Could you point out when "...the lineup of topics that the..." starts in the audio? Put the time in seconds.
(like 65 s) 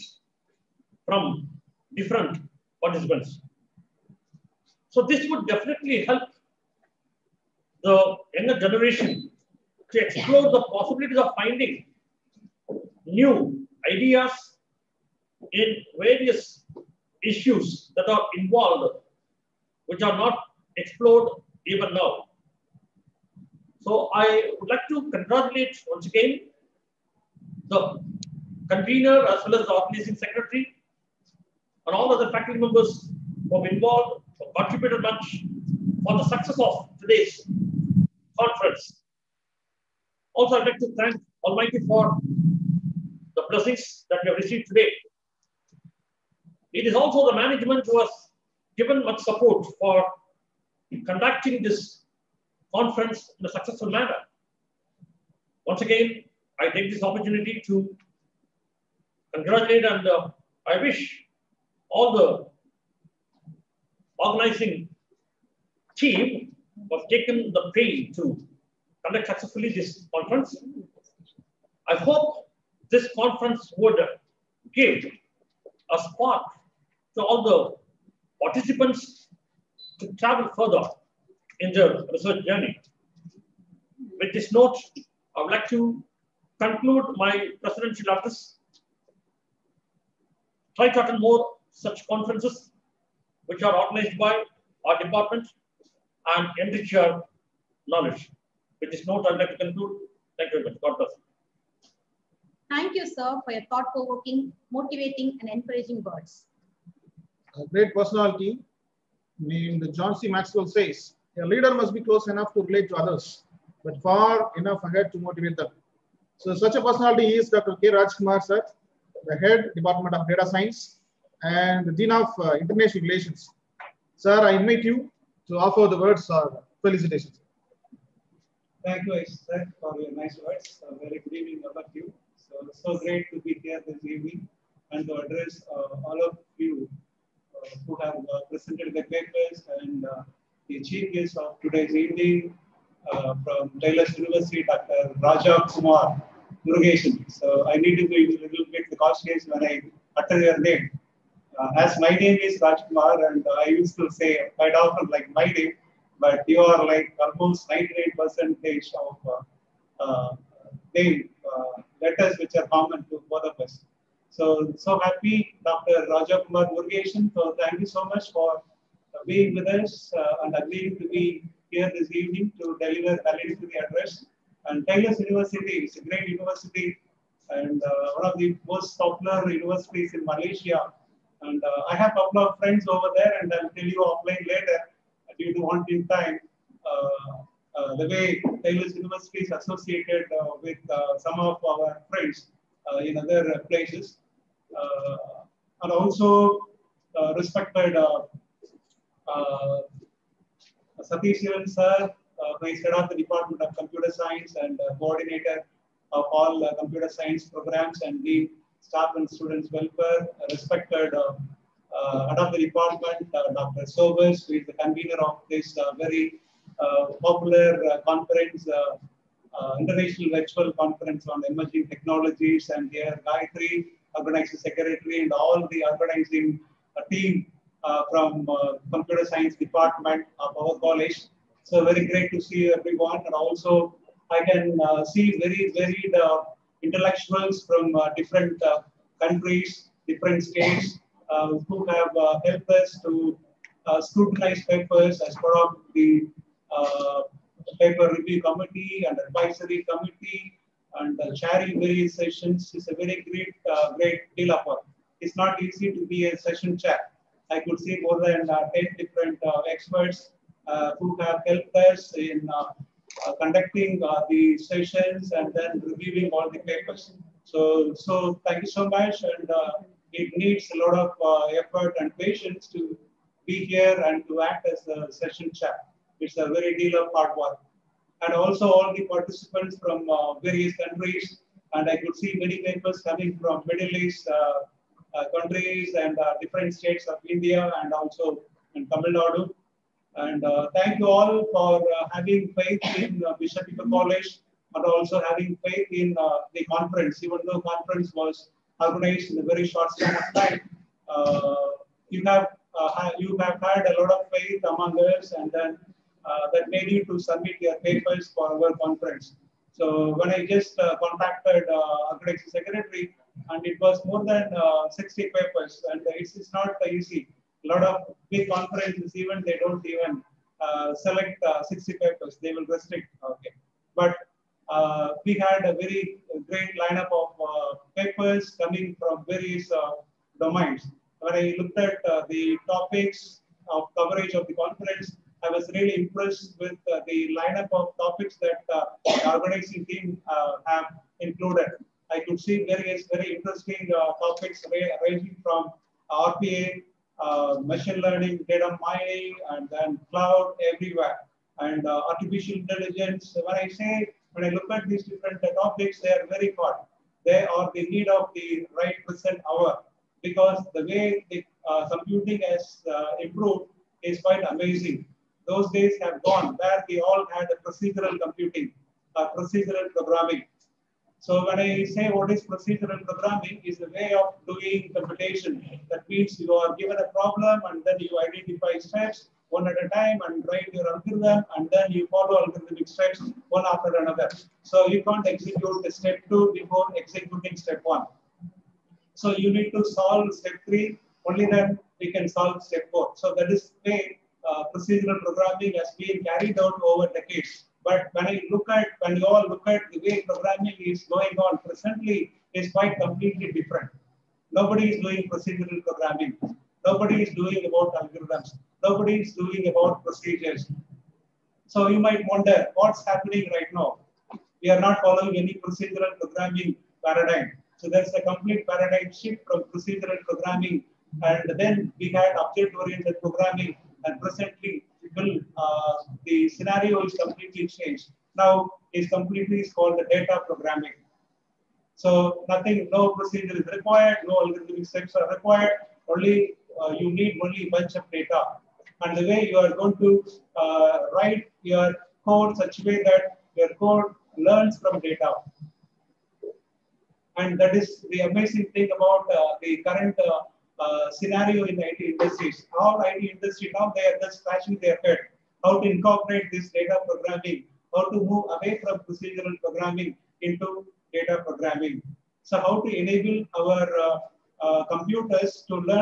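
337 s.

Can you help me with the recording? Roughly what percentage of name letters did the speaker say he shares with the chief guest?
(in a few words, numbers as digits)
98.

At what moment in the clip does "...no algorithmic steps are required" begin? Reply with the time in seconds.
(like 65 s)
434 s.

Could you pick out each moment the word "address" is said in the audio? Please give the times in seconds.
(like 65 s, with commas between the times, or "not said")
88 s, 135 s, 173 s.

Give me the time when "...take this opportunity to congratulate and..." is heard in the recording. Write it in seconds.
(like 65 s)
56 s.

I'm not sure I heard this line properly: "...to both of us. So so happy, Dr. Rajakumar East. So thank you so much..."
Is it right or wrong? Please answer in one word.
wrong.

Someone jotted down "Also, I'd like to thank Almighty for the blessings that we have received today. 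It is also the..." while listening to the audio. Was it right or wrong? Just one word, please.
right.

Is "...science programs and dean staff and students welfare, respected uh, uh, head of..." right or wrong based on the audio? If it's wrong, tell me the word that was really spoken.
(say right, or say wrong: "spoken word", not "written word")
right.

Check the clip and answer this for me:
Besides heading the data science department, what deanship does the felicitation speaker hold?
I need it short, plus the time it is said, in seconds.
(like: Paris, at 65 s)
International relations, at 122 s.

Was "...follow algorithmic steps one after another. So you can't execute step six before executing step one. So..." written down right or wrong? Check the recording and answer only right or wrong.
wrong.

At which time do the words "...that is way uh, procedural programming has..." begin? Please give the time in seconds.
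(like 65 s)
393 s.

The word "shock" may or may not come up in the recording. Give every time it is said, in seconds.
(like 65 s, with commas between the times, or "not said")
not said.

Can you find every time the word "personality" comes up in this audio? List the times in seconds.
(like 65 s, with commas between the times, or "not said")
107 s, 116 s.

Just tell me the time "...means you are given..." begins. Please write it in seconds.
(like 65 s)
376 s.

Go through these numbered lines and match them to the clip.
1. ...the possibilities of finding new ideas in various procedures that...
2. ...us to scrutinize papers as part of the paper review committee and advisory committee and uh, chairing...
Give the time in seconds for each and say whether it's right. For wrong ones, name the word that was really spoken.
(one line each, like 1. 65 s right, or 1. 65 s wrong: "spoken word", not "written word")
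1. 10 s wrong: "issues", not "procedures"
2. 242 s right.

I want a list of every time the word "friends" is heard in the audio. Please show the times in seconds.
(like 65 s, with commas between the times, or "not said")
182 s, 192 s.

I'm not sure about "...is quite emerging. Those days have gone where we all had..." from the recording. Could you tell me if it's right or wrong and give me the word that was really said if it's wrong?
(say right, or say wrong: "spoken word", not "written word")
wrong: "amazing", not "emerging".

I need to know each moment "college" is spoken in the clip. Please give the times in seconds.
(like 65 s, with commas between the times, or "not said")
230 s, 293 s.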